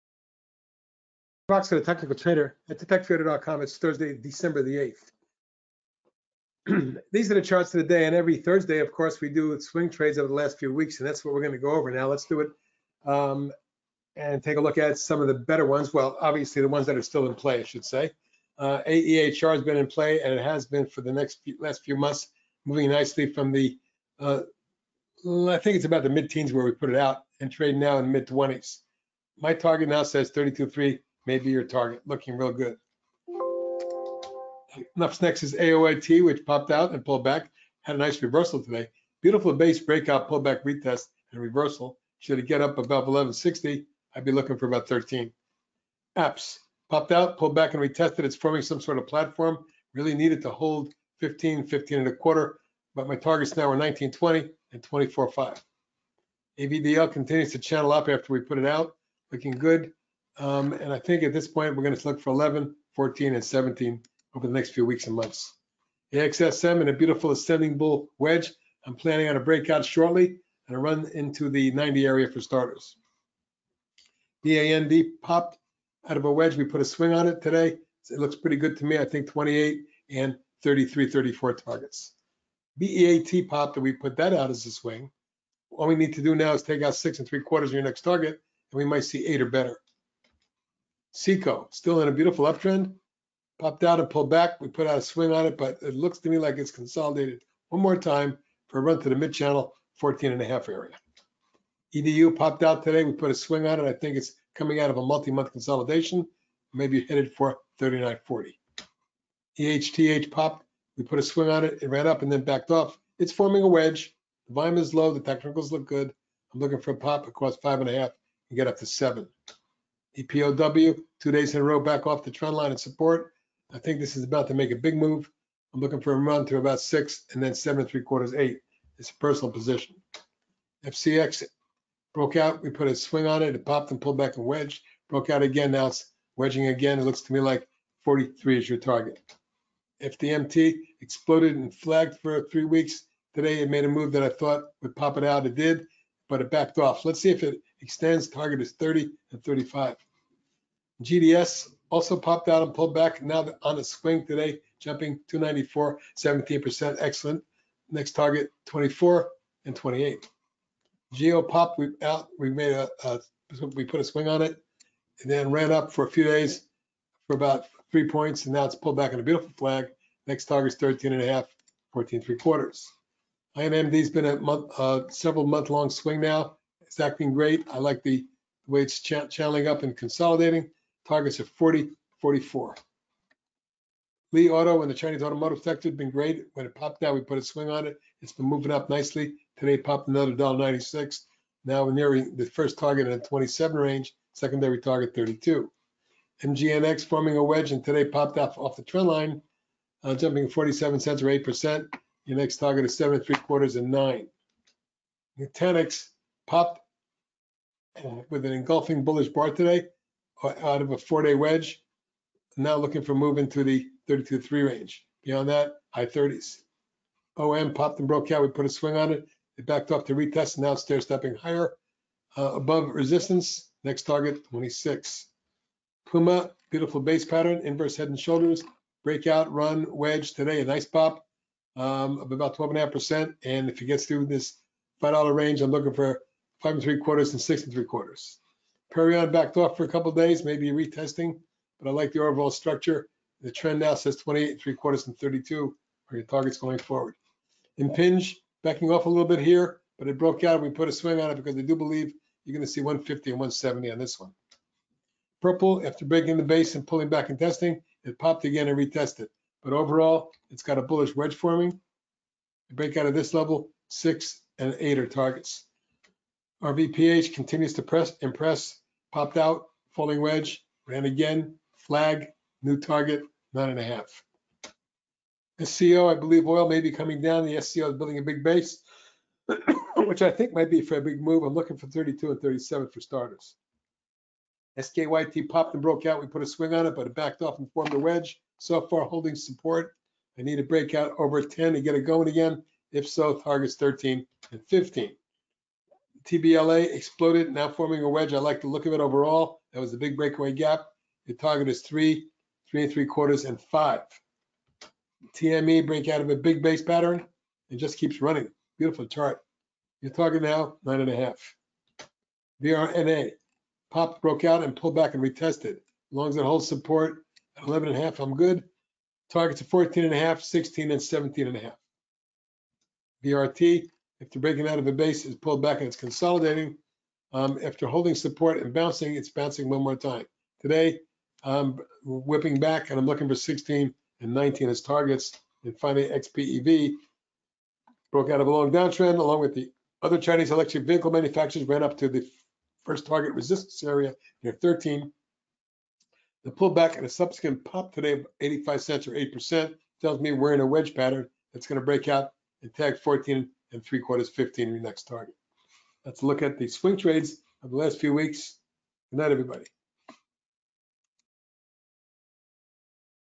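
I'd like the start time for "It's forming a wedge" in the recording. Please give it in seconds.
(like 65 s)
113 s.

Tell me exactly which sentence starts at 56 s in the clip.
AVDL continues to channel up after we put it out.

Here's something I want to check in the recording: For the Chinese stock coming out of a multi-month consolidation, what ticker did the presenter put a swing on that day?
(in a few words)
EDU.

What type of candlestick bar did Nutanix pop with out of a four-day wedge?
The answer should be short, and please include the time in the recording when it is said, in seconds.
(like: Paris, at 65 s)
Engulfing bullish bar, at 208 s.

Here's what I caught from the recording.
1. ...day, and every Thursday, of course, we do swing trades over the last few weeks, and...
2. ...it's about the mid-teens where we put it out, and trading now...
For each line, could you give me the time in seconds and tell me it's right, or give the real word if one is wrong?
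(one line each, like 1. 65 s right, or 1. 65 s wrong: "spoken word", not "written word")
1. 7 s right
2. 25 s right.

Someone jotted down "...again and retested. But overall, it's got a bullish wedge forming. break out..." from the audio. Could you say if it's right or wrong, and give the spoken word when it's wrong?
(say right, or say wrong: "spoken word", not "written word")
right.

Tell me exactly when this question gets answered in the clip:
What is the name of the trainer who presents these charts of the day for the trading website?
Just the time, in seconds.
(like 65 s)
1 s.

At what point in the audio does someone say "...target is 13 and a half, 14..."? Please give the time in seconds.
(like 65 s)
170 s.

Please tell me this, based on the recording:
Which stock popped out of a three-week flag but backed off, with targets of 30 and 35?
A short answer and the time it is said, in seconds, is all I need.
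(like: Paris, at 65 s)
FDMT, at 140 s.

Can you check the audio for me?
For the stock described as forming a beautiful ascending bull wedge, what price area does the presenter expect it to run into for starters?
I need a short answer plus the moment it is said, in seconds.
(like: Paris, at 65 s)
90, at 71 s.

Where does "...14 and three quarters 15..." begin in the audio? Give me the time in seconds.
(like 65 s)
352 s.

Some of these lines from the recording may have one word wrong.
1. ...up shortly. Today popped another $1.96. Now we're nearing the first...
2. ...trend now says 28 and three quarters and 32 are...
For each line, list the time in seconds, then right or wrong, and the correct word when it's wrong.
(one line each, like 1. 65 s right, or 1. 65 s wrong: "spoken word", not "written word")
1. 188 s wrong: "nicely", not "shortly"
2. 243 s right.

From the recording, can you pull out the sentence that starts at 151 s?
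GDS also popped out and pulled back, now on a swing today, jumping 294, 17%, excellent.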